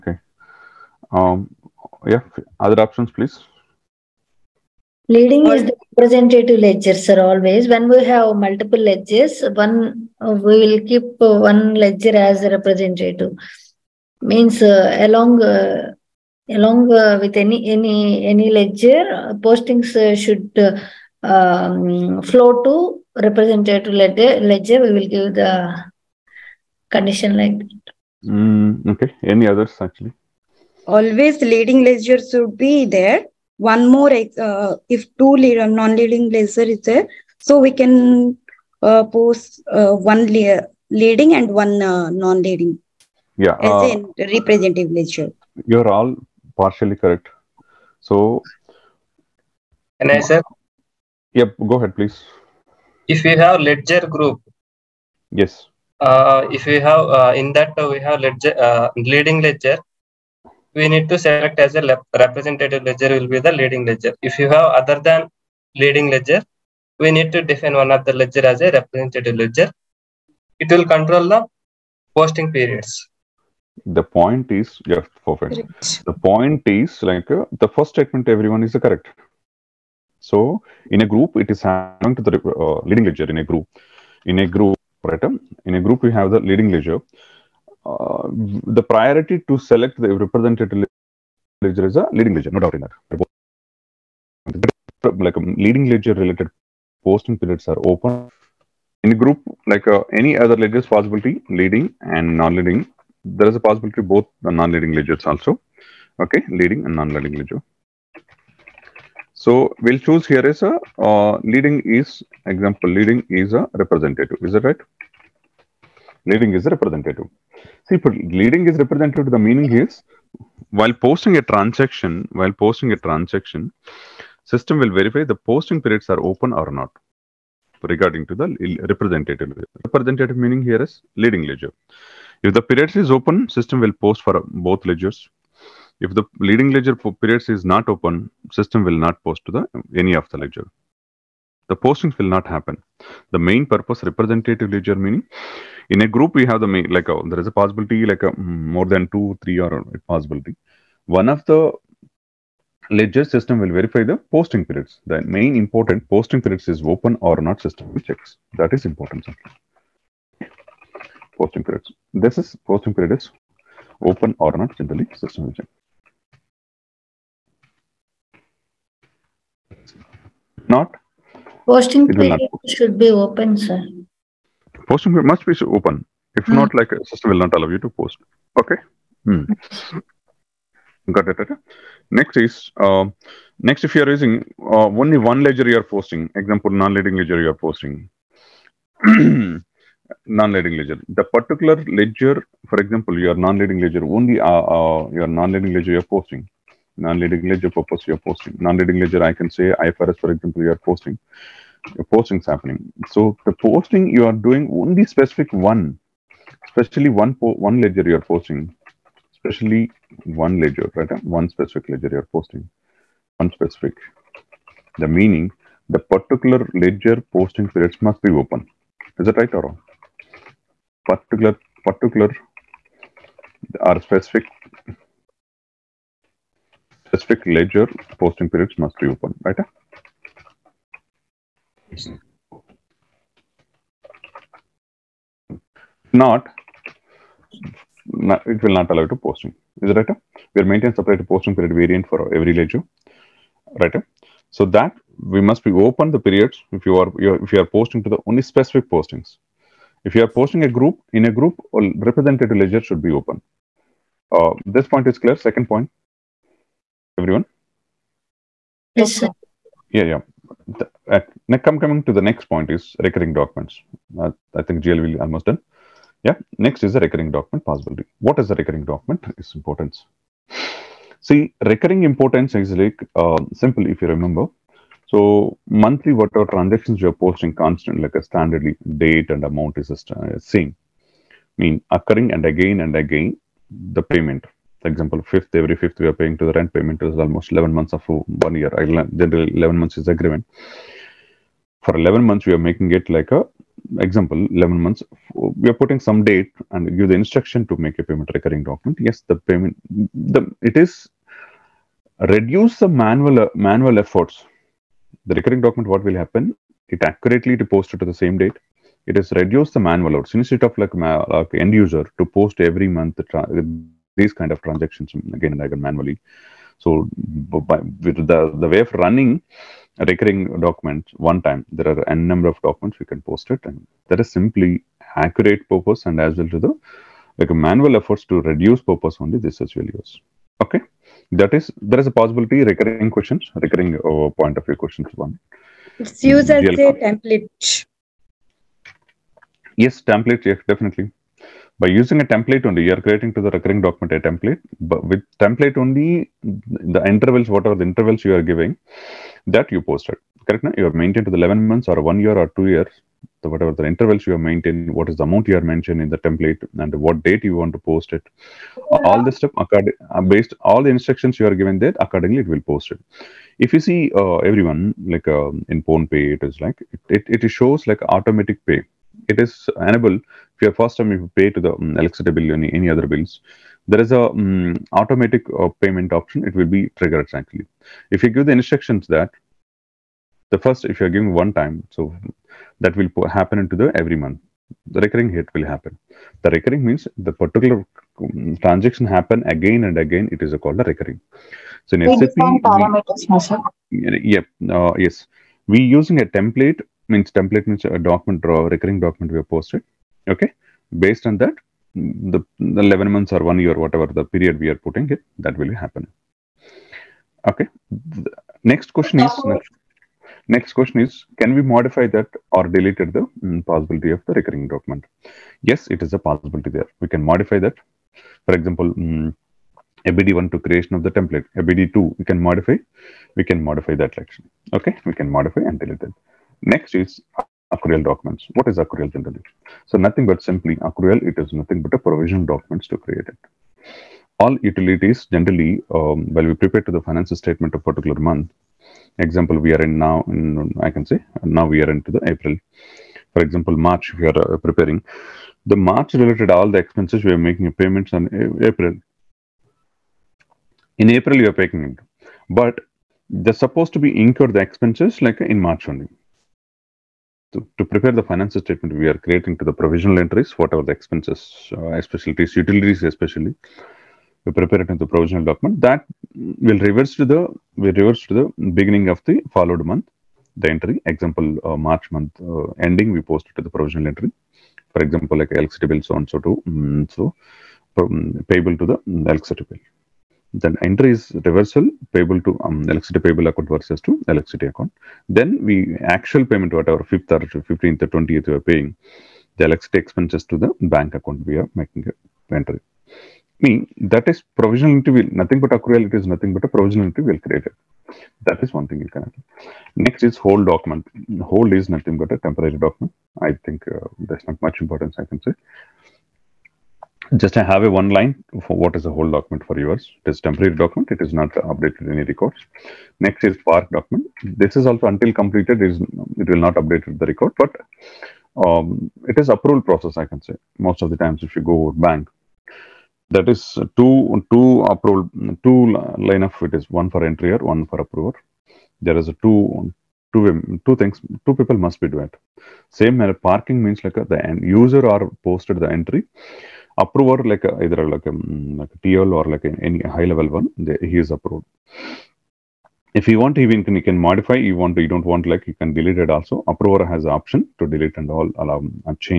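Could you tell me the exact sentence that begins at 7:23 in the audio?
For example, March, we are uh, preparing.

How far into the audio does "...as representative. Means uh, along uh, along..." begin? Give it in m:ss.
0:12.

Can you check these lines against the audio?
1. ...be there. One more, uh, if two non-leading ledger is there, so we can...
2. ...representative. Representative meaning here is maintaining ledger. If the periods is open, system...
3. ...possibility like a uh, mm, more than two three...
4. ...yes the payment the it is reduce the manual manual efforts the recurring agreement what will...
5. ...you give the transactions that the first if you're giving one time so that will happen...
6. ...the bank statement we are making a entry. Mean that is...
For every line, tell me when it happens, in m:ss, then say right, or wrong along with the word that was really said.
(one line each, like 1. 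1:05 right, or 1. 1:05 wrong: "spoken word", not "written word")
1. 0:32 right
2. 2:08 wrong: "leading", not "maintaining"
3. 2:27 right
4. 4:59 wrong: "document", not "agreement"
5. 6:18 wrong: "instructions", not "transactions"
6. 8:10 wrong: "account", not "statement".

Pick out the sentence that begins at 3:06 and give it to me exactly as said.
Example, non-leading ledger you are posting.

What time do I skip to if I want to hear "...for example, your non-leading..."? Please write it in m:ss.
3:12.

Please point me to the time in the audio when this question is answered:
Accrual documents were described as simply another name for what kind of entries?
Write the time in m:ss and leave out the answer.
7:11.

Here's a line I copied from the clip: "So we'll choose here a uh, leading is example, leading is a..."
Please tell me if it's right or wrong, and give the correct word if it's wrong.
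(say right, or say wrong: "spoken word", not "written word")
right.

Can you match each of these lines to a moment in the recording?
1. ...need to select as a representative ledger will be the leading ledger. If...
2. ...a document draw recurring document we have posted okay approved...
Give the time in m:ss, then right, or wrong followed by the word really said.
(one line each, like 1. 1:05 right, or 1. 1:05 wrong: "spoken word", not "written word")
1. 1:00 right
2. 6:37 wrong: "based", not "approved".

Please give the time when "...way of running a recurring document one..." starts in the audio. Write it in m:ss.
5:18.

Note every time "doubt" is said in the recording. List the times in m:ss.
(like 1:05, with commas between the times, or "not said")
1:32.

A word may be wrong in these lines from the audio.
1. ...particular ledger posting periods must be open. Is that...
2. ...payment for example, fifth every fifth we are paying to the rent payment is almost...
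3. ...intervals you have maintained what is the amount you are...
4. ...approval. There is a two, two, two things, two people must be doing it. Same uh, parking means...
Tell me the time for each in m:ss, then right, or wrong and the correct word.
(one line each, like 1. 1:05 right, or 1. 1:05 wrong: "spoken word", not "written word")
1. 3:35 right
2. 4:44 right
3. 5:53 right
4. 8:48 right.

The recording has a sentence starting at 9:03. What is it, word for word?
If you want, even you can modify.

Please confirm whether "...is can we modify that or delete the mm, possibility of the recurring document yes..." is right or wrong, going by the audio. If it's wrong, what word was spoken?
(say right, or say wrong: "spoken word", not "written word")
right.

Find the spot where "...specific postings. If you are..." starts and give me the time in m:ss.
4:08.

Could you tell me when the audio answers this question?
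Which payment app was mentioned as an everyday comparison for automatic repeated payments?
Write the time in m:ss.
6:05.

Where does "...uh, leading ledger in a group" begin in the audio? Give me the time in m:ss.
1:22.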